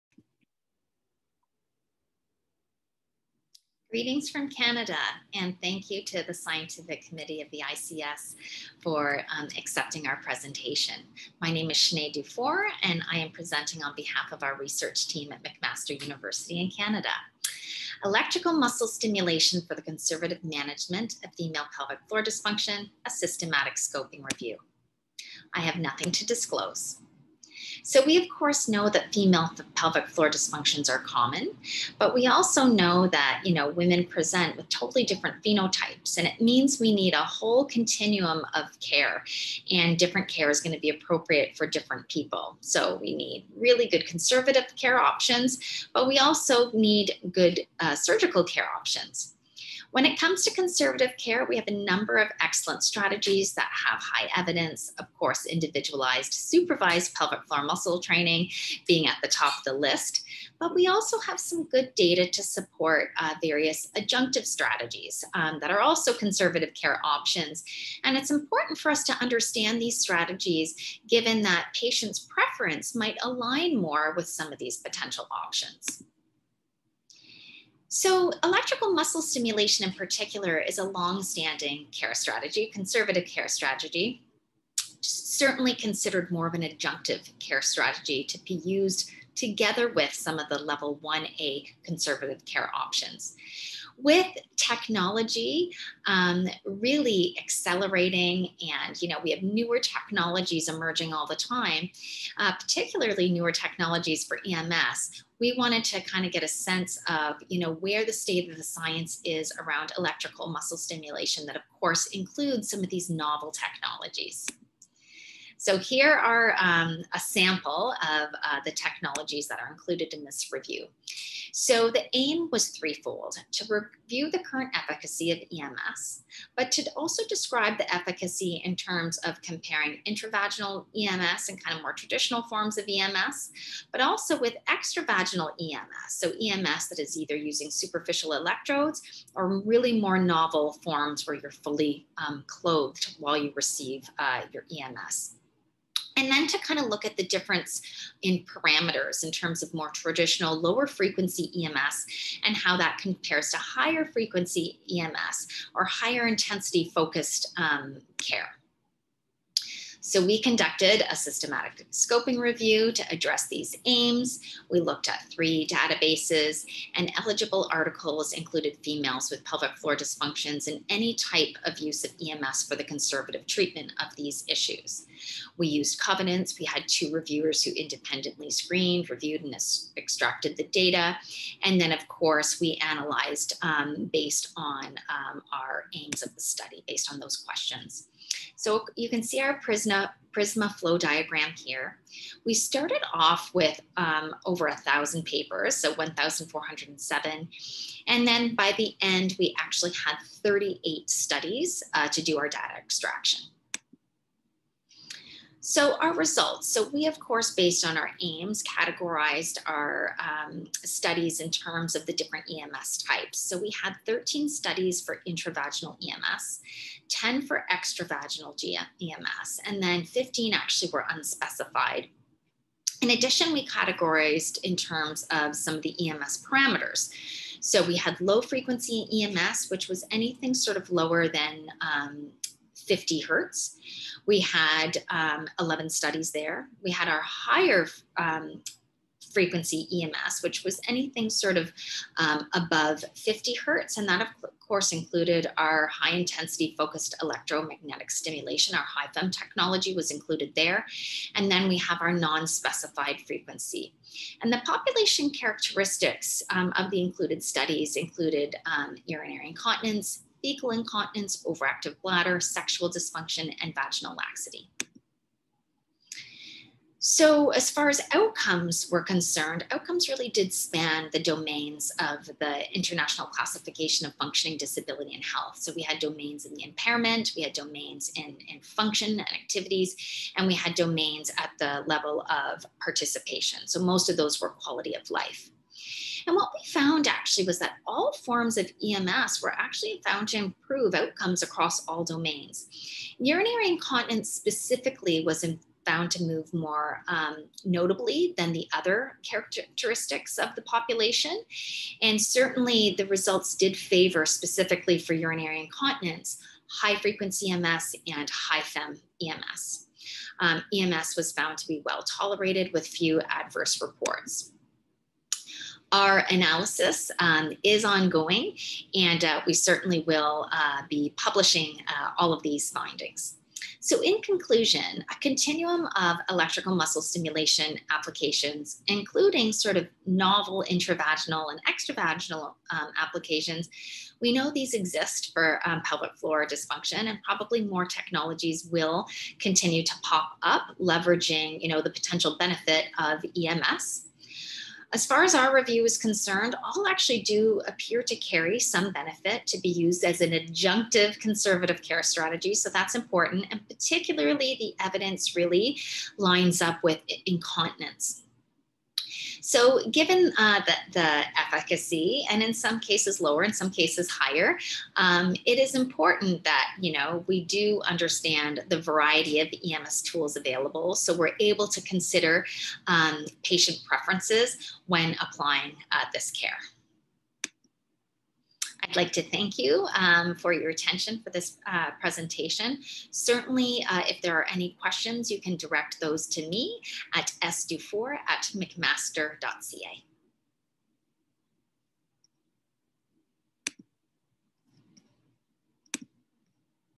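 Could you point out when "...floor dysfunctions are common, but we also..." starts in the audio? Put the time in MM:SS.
00:30.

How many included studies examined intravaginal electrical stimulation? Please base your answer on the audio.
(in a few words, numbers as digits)
13.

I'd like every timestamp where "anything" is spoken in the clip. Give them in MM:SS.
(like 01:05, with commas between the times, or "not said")
03:50, 04:00.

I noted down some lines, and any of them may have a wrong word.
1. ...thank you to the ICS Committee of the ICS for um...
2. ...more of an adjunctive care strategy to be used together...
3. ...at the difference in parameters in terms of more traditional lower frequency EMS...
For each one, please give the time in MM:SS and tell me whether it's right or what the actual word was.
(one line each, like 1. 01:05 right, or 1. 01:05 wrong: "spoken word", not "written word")
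1. 00:05 wrong: "Scientific", not "ICS"
2. 01:26 right
3. 02:27 right.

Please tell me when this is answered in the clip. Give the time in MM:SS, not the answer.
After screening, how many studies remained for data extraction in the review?
03:20.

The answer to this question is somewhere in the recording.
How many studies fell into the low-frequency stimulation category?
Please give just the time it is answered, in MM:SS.
03:55.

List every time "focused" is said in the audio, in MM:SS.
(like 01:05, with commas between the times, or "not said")
02:36, 04:06.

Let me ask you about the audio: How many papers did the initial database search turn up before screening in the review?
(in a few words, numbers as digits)
1,407.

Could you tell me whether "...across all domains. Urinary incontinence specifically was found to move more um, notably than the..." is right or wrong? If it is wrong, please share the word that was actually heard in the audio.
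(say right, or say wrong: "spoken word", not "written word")
right.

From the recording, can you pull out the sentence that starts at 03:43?
In addition, we categorized in terms of some of the EMS parameters.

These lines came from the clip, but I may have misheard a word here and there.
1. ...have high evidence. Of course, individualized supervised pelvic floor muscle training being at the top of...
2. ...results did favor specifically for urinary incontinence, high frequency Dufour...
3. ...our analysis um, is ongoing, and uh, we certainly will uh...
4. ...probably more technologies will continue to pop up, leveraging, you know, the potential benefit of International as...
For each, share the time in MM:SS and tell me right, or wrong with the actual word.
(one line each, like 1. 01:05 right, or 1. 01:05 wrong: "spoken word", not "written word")
1. 00:53 right
2. 05:03 wrong: "EMS", not "Dufour"
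3. 05:15 right
4. 05:37 wrong: "EMS", not "International".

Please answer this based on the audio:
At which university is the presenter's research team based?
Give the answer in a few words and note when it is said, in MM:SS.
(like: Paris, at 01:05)
McMaster University, at 00:15.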